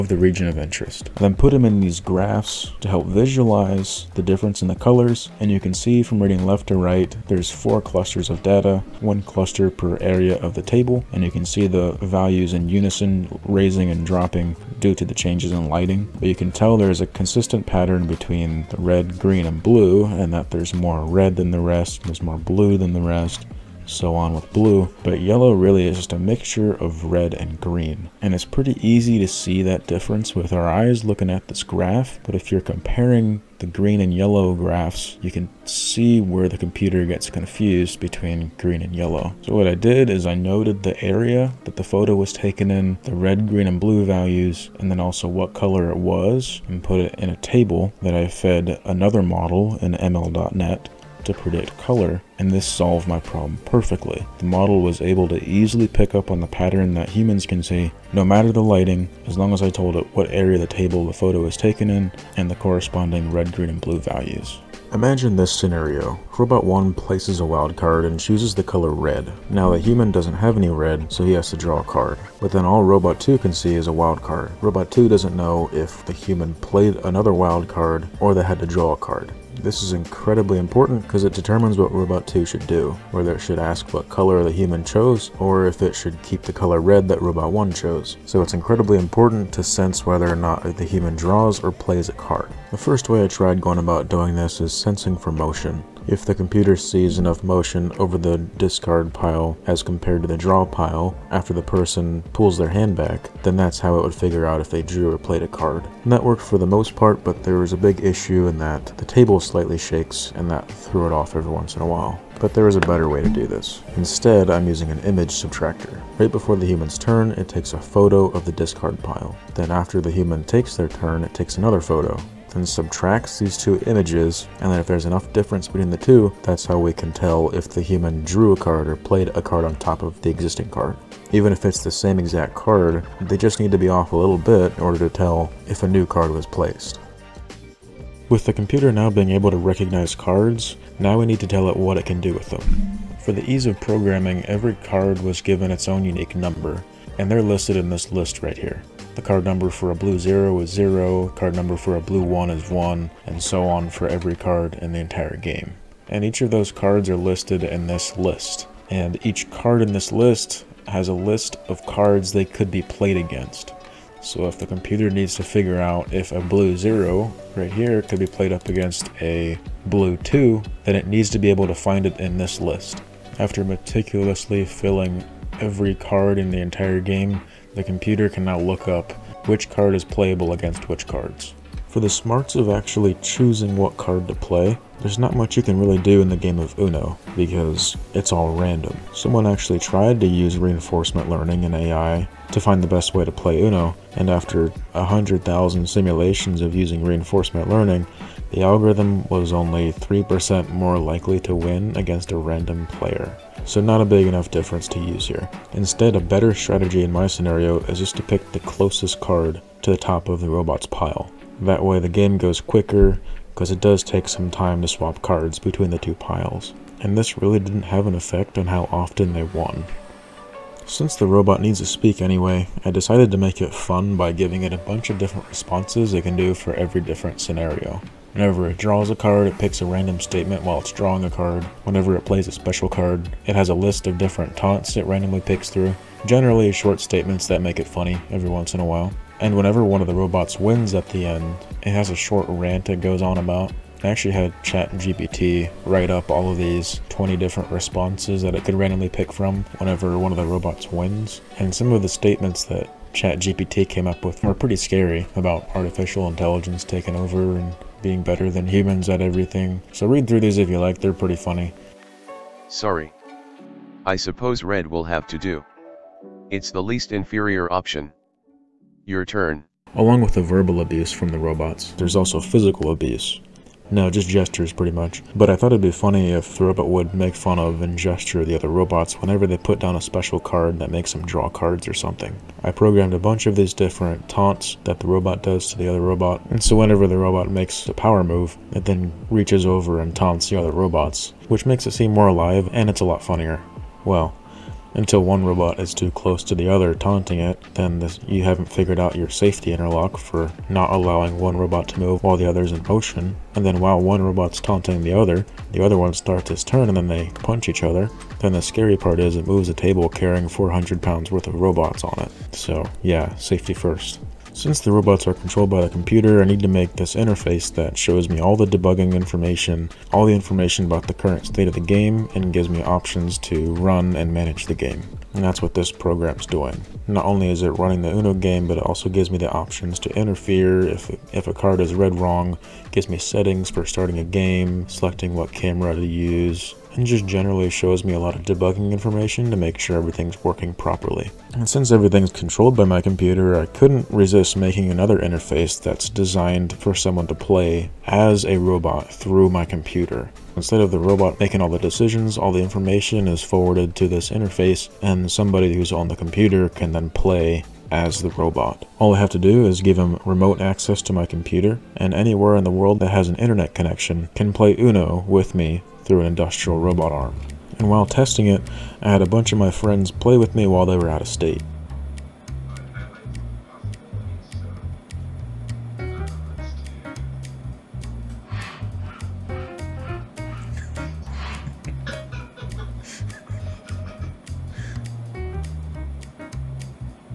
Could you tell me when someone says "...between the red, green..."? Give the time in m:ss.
0:18.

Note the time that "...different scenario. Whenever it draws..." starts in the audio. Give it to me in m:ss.
3:46.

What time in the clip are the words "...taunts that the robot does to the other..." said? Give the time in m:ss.
4:44.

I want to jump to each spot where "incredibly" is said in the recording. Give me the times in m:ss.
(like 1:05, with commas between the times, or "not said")
1:19, 1:28.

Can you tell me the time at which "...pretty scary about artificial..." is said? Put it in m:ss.
4:14.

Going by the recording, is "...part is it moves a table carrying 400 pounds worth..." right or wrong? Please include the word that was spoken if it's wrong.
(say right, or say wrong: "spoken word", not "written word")
right.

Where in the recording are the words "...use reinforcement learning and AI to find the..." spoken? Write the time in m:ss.
3:10.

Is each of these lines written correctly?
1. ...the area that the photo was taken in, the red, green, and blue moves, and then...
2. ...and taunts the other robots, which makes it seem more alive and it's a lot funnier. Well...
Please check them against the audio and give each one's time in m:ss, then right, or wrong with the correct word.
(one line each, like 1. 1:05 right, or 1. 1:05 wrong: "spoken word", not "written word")
1. 0:40 wrong: "values", not "moves"
2. 4:49 right.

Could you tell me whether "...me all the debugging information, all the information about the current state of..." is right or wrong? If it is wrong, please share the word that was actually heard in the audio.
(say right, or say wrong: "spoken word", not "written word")
right.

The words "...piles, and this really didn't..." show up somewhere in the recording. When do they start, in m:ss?
3:36.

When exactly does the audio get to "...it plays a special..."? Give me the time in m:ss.
3:52.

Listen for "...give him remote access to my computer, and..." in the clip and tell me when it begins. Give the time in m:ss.
5:59.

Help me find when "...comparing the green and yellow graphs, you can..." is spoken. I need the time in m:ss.
0:32.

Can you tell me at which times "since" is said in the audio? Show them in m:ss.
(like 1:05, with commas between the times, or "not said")
3:40, 5:14, 5:41.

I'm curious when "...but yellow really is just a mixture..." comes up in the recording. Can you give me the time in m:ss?
0:25.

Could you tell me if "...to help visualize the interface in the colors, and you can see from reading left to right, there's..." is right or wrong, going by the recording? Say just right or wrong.
wrong.